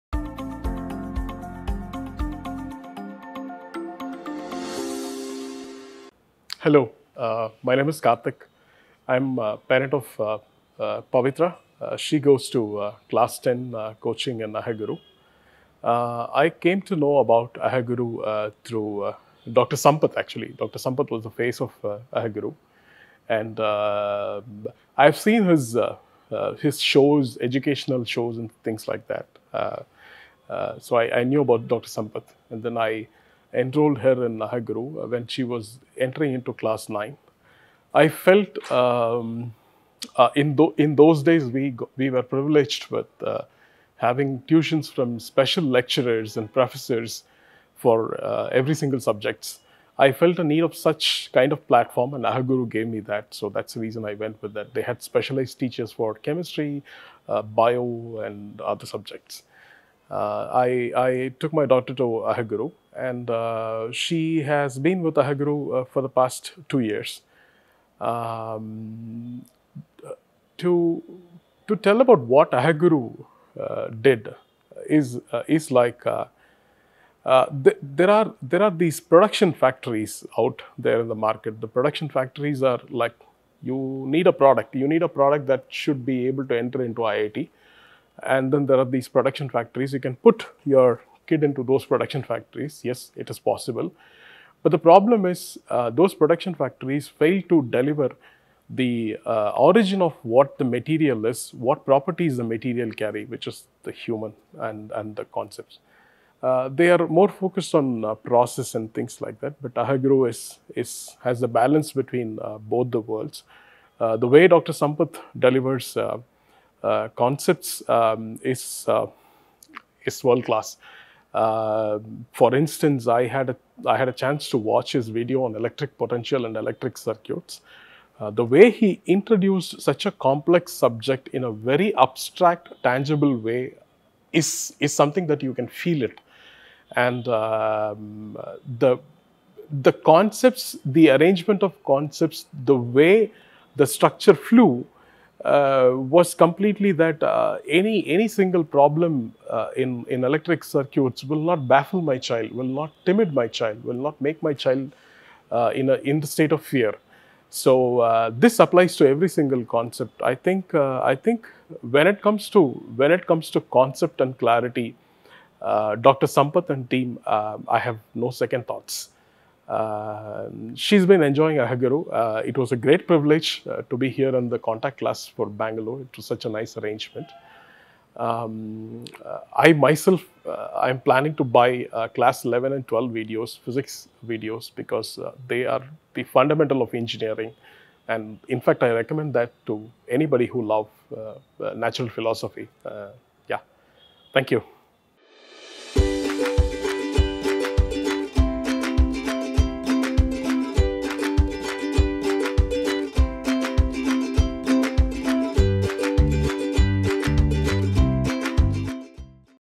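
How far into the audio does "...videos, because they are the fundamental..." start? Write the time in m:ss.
3:04.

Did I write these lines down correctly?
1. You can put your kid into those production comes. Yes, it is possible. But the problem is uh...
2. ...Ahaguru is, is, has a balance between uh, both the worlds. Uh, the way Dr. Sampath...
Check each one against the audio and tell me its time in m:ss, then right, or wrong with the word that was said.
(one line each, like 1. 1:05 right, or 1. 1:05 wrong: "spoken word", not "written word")
1. 1:29 wrong: "factories", not "comes"
2. 1:49 right.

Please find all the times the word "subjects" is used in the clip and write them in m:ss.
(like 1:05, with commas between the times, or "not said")
0:48, 0:58, 2:10.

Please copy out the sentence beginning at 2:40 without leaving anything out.
I think uh, I think when it comes to when it comes to concept and clarity, Dr.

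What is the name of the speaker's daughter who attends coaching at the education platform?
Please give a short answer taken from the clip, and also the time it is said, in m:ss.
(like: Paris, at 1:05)
Pavitra, at 0:11.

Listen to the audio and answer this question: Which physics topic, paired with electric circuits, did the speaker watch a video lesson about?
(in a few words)
electric potential.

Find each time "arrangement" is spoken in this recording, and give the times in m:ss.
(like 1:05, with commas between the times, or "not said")
2:21, 2:56.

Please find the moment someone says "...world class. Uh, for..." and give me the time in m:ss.
2:00.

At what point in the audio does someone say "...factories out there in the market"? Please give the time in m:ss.
1:19.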